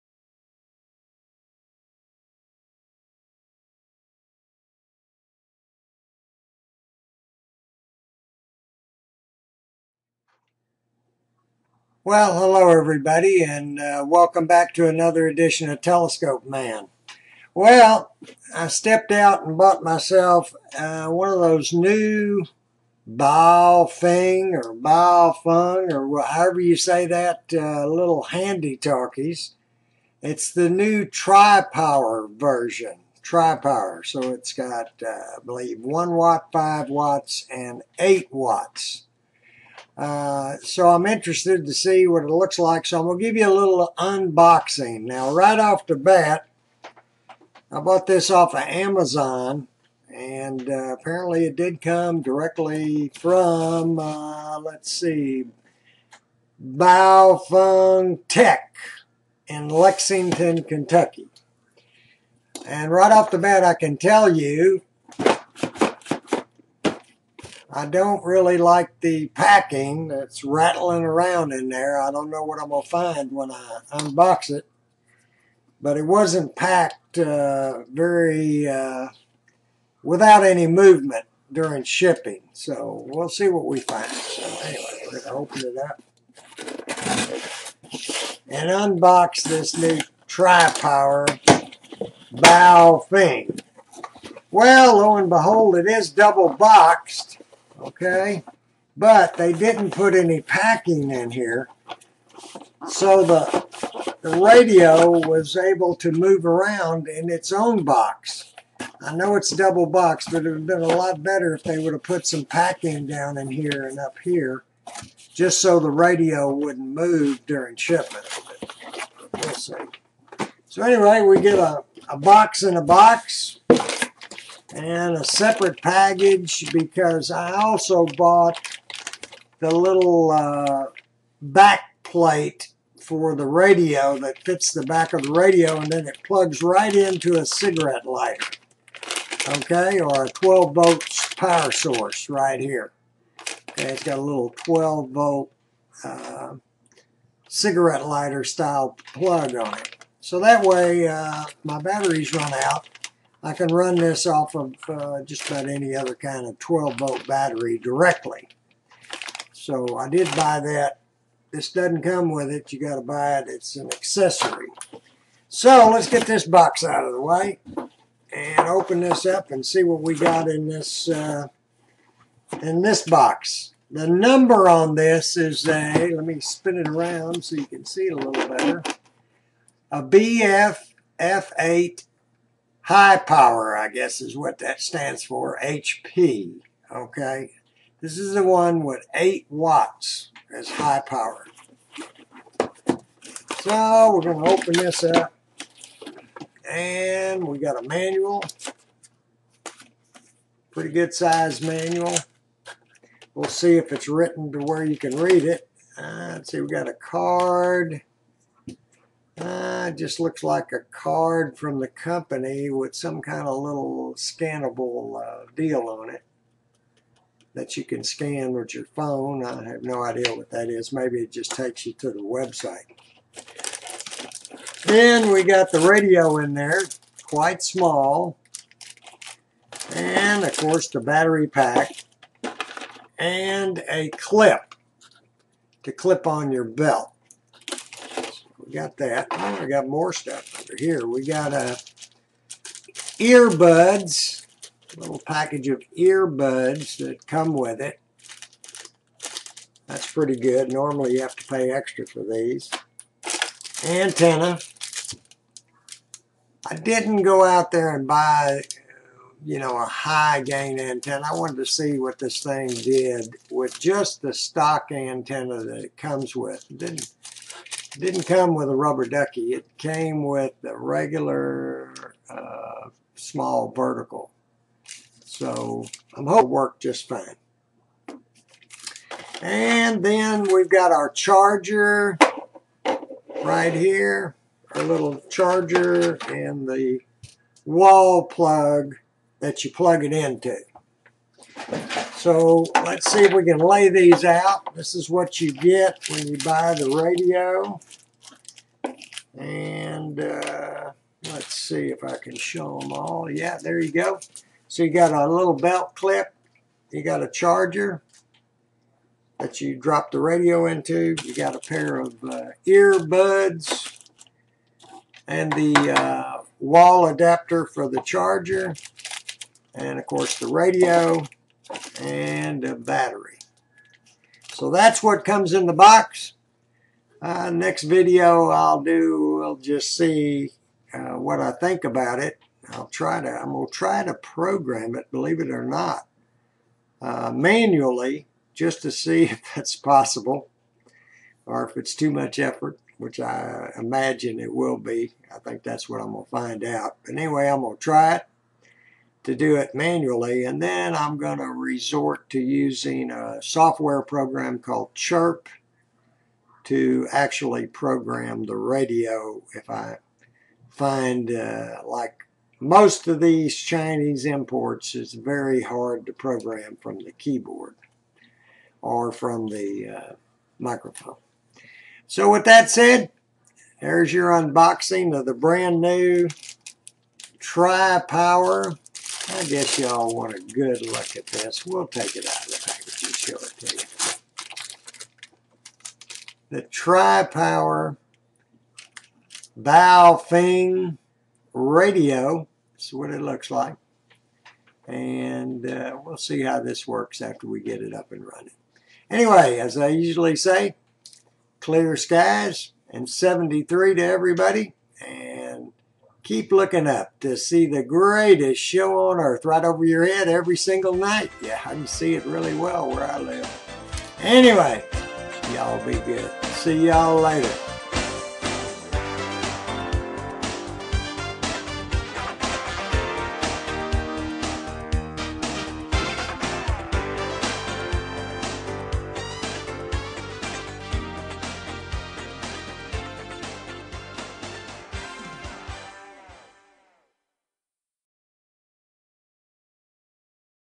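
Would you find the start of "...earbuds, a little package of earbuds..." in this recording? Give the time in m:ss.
4:03.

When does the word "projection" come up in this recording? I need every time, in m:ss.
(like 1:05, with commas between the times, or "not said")
not said.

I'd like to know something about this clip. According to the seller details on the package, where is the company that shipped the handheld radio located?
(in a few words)
Lexington, Kentucky.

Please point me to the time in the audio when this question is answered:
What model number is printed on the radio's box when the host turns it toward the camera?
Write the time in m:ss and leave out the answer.
3:00.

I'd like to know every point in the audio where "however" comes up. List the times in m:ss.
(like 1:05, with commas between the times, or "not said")
0:26.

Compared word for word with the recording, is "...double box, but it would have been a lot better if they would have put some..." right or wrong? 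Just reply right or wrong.
right.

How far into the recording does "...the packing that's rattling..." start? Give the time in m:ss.
1:08.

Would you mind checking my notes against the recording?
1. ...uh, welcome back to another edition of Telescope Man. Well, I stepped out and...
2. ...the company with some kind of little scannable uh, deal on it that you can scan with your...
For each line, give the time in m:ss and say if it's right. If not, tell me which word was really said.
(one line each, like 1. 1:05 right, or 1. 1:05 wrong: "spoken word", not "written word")
1. 0:13 right
2. 3:31 right.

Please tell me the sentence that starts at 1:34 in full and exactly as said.
Well, lo and behold, it is double boxed okay?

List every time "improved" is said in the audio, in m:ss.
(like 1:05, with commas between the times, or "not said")
not said.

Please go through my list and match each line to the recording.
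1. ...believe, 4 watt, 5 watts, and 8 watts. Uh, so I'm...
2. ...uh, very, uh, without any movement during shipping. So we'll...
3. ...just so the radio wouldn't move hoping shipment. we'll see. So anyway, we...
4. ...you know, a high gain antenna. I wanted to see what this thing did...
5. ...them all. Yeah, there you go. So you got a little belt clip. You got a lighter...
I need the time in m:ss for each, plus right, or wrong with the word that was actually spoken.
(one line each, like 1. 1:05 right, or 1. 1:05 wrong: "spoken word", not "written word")
1. 0:35 wrong: "1", not "4"
2. 1:17 right
3. 1:55 wrong: "during", not "hoping"
4. 4:19 right
5. 5:02 wrong: "charger", not "lighter".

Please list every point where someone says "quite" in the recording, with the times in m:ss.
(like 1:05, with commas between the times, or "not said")
3:47.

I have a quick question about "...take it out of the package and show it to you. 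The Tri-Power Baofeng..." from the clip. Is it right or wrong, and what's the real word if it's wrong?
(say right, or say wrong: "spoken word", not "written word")
right.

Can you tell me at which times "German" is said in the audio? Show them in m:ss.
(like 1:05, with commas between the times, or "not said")
not said.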